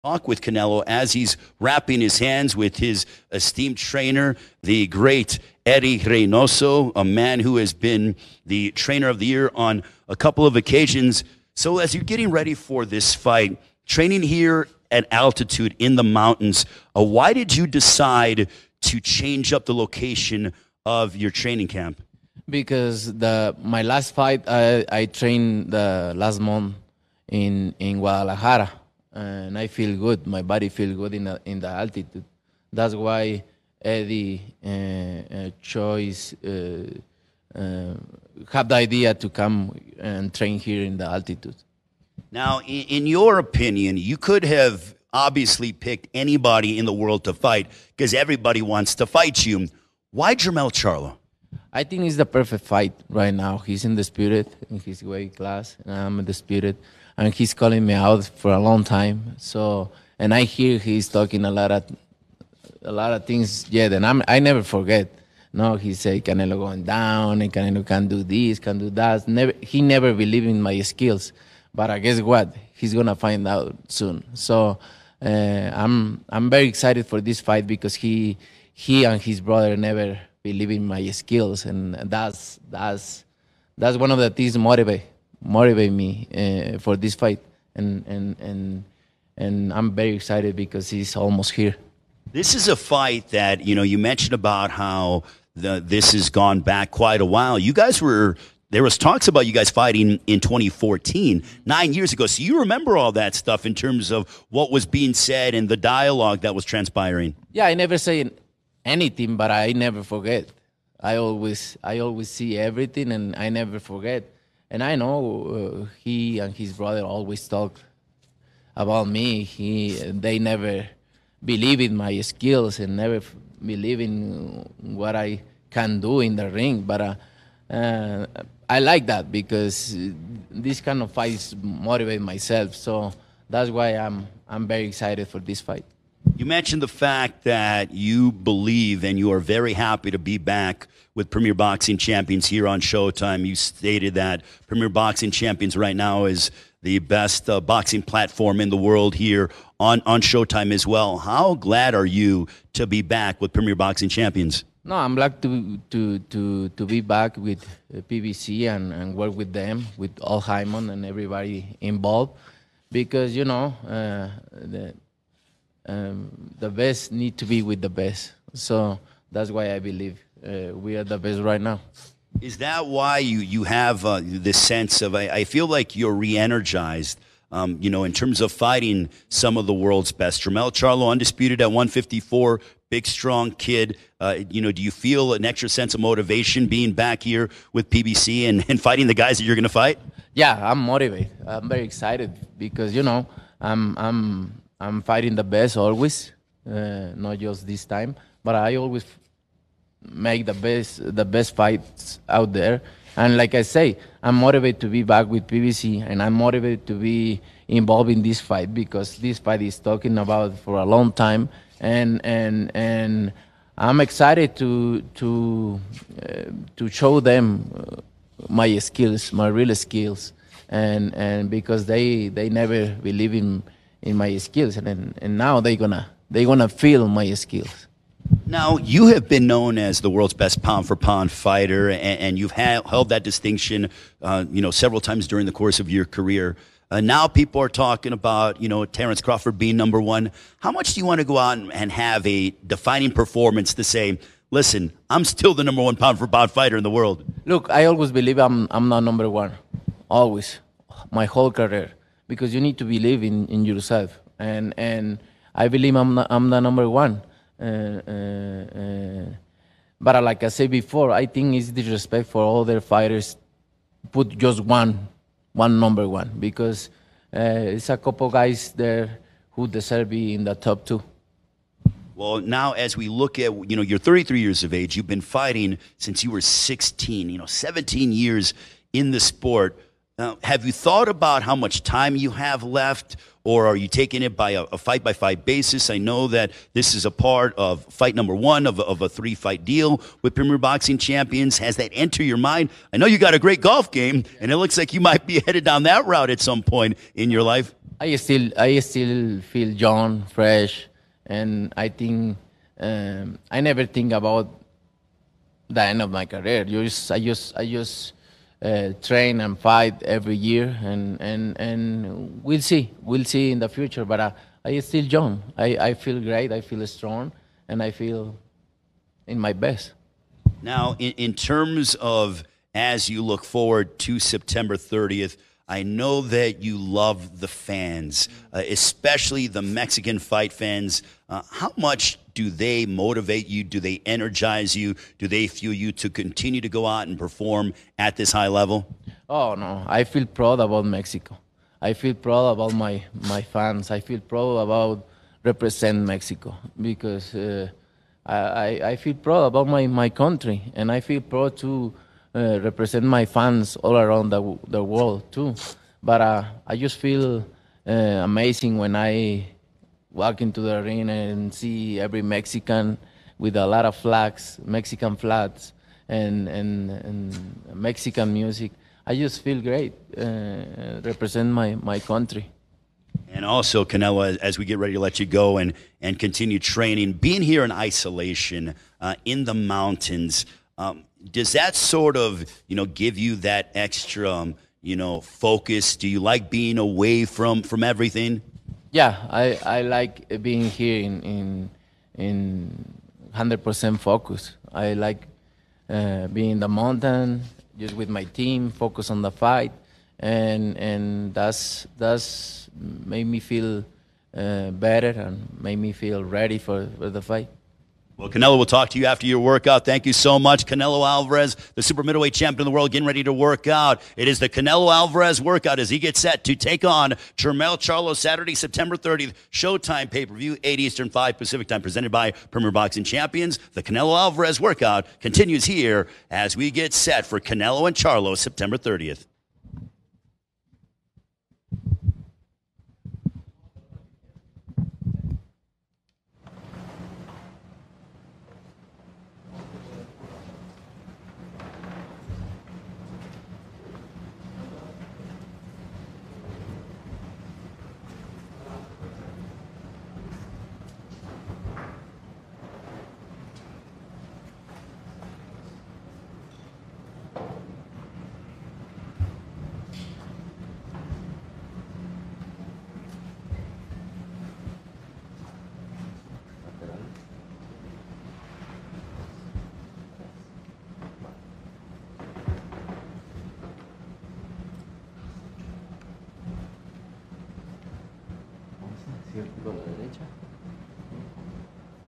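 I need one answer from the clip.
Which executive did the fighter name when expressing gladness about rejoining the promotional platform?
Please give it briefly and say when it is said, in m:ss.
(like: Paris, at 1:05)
Al Haymon, at 2:40.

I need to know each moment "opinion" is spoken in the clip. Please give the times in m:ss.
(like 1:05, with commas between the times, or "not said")
0:43.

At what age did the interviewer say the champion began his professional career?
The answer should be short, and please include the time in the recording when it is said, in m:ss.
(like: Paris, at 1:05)
16, at 4:36.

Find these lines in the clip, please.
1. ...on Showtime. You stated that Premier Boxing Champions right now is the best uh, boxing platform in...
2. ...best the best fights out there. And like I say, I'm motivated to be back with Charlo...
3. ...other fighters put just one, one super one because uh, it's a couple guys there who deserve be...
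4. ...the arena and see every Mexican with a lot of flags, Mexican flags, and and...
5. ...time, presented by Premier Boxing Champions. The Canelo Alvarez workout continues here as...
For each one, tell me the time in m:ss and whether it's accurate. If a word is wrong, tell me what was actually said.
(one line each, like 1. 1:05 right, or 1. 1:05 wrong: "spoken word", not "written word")
1. 2:22 right
2. 3:20 wrong: "PBC", not "Charlo"
3. 4:22 wrong: "number", not "super"
4. 6:00 right
5. 7:01 right.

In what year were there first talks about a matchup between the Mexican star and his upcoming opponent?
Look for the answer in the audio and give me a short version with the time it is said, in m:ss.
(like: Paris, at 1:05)
2014, at 1:40.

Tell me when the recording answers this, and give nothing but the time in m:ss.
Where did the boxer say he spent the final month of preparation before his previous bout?
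0:27.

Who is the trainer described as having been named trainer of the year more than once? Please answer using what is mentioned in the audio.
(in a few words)
Eddie Reynoso.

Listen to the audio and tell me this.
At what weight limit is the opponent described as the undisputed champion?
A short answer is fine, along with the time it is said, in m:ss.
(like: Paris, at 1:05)
154, at 3:01.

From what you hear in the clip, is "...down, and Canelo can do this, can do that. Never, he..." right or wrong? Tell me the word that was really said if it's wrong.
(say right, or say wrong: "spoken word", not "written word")
right.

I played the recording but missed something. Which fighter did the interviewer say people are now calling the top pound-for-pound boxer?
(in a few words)
Terrence Crawford.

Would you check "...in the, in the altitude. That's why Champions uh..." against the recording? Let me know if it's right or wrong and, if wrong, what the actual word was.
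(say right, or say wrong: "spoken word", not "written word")
wrong: "Eddie", not "Champions".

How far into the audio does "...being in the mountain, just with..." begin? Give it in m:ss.
6:36.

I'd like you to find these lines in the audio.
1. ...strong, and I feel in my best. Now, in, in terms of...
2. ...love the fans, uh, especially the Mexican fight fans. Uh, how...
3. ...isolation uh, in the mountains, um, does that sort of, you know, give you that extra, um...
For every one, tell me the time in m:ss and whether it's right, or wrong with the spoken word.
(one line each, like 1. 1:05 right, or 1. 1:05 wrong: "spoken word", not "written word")
1. 5:16 right
2. 5:26 right
3. 6:17 right.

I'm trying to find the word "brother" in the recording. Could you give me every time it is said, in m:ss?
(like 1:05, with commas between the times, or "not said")
1:19, 1:56.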